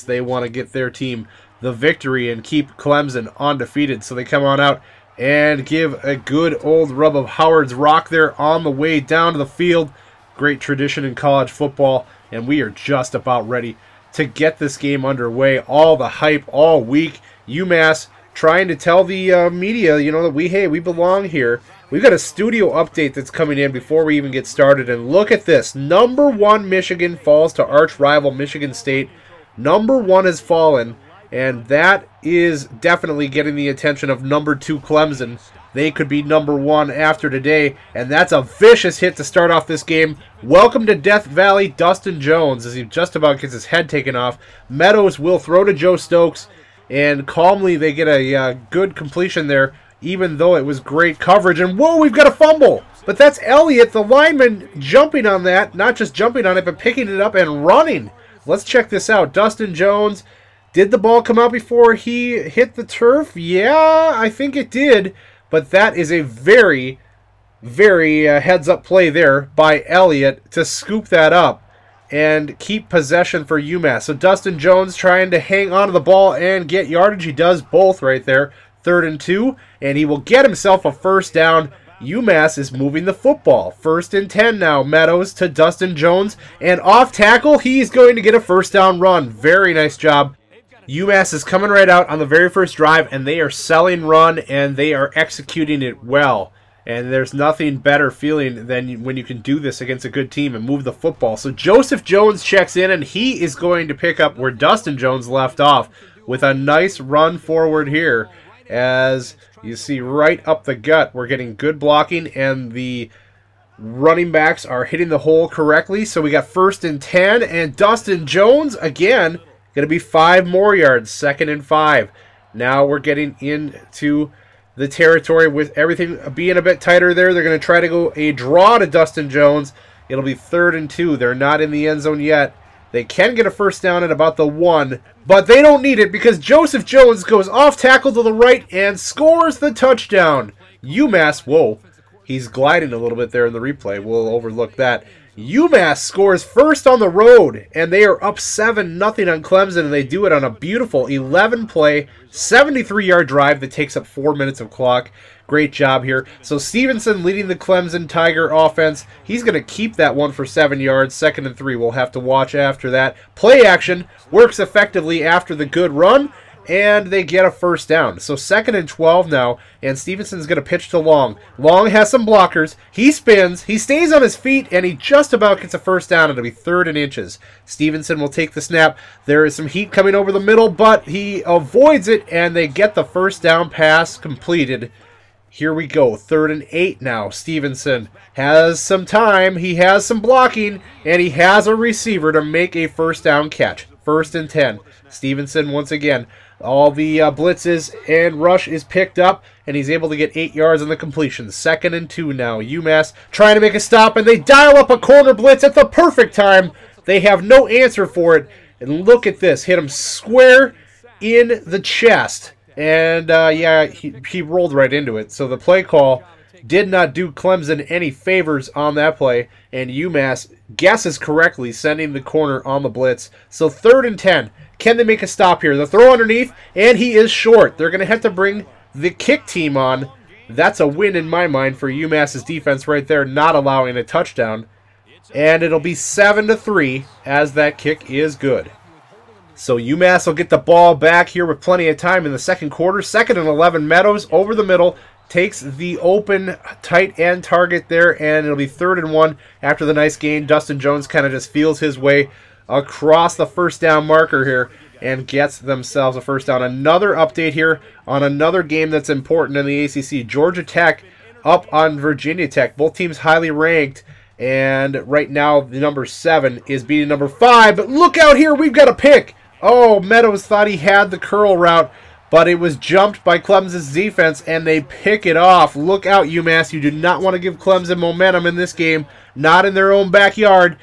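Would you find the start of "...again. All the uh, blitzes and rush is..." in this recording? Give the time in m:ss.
3:15.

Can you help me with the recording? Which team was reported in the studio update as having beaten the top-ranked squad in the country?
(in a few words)
Michigan State.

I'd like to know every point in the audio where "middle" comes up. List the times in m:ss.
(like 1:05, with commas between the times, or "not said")
3:00, 4:04.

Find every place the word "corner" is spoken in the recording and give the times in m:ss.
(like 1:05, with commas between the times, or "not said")
3:24, 3:42.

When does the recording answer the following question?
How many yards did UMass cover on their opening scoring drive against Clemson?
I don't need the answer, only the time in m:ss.
2:32.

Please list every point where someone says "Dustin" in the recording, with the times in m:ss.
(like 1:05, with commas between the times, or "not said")
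0:41, 0:59, 1:14, 1:25, 1:44, 1:57, 2:08, 4:10.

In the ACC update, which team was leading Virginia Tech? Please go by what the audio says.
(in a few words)
Georgia Tech.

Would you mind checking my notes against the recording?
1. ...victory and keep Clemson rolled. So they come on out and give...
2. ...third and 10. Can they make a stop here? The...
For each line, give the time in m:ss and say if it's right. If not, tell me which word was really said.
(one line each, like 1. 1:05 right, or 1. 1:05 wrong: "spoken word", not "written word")
1. 0:01 wrong: "undefeated", not "rolled"
2. 3:43 right.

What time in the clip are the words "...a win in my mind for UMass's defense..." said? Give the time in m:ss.
3:50.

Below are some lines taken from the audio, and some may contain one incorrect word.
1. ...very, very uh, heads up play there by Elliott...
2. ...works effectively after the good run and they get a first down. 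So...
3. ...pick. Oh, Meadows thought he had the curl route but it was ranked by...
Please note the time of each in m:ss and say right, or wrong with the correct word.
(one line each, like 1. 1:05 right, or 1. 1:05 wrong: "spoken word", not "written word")
1. 1:06 right
2. 2:44 right
3. 4:28 wrong: "jumped", not "ranked".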